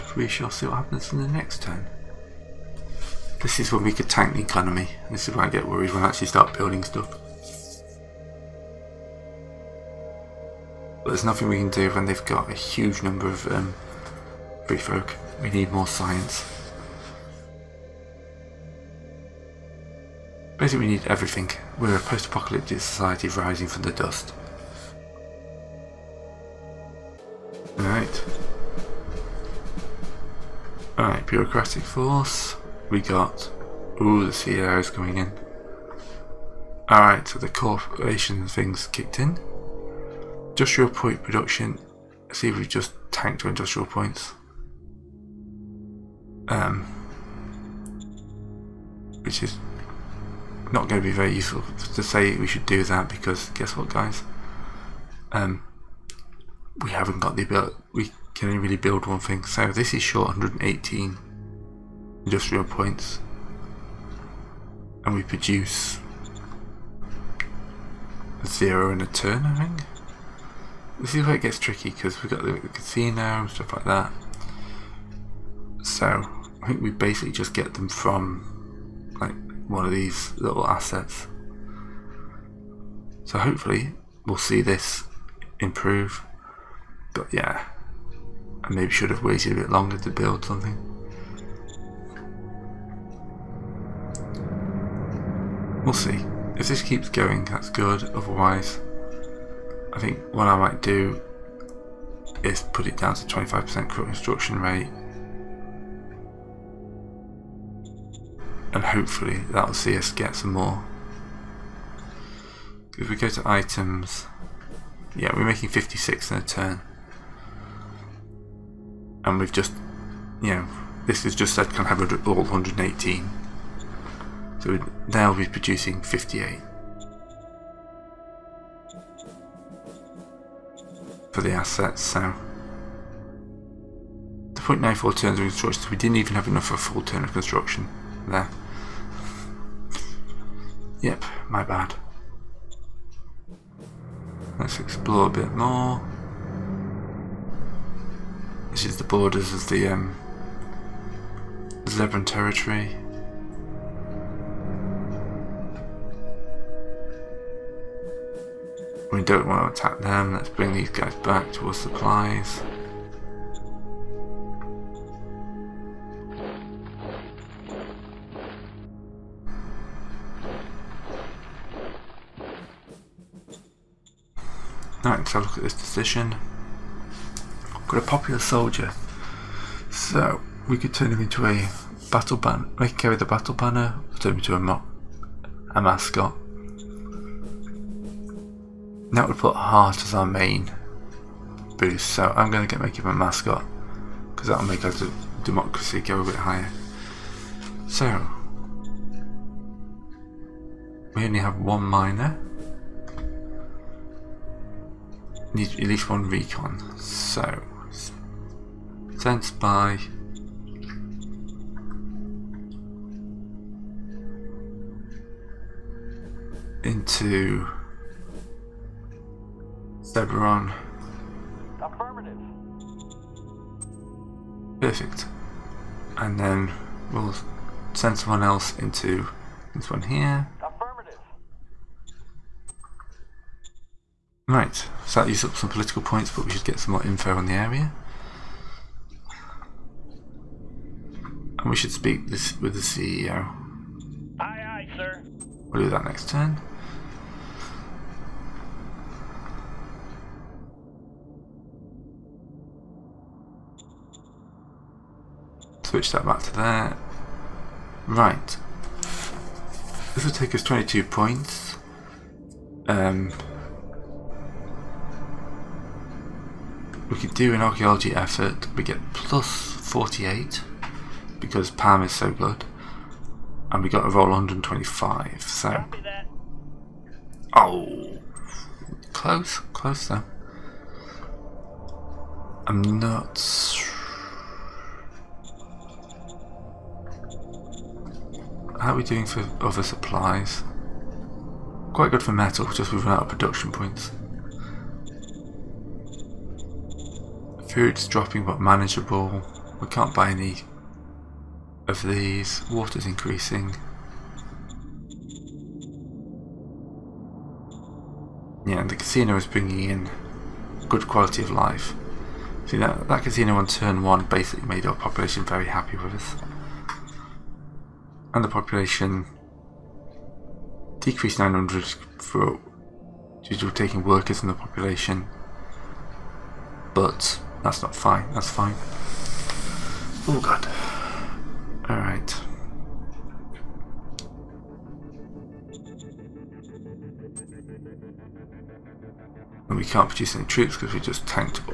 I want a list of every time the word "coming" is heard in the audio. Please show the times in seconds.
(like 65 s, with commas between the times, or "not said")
34 s.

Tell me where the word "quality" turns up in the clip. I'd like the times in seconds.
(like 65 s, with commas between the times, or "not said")
311 s.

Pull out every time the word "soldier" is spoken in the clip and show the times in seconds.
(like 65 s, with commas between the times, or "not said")
178 s.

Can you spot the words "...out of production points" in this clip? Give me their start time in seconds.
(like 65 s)
293 s.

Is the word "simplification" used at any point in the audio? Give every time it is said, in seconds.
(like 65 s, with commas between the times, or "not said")
not said.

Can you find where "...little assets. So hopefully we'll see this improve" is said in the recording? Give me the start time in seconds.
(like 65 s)
80 s.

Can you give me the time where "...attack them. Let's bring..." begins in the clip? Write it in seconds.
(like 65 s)
159 s.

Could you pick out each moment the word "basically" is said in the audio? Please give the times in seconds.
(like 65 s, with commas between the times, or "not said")
20 s, 76 s, 314 s.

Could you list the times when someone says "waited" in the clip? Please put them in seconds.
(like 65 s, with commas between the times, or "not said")
89 s.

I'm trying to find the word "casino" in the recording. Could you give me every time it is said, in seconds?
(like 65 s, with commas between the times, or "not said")
72 s, 308 s, 313 s.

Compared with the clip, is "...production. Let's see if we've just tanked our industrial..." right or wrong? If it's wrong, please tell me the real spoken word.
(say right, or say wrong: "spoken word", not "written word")
right.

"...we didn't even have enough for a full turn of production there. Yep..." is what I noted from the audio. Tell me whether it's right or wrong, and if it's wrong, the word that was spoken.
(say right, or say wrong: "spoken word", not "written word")
wrong: "construction", not "production".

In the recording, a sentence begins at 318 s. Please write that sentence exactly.
And the population decreased 900 for due to taking workers in the population.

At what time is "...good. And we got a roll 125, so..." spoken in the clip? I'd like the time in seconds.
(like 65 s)
272 s.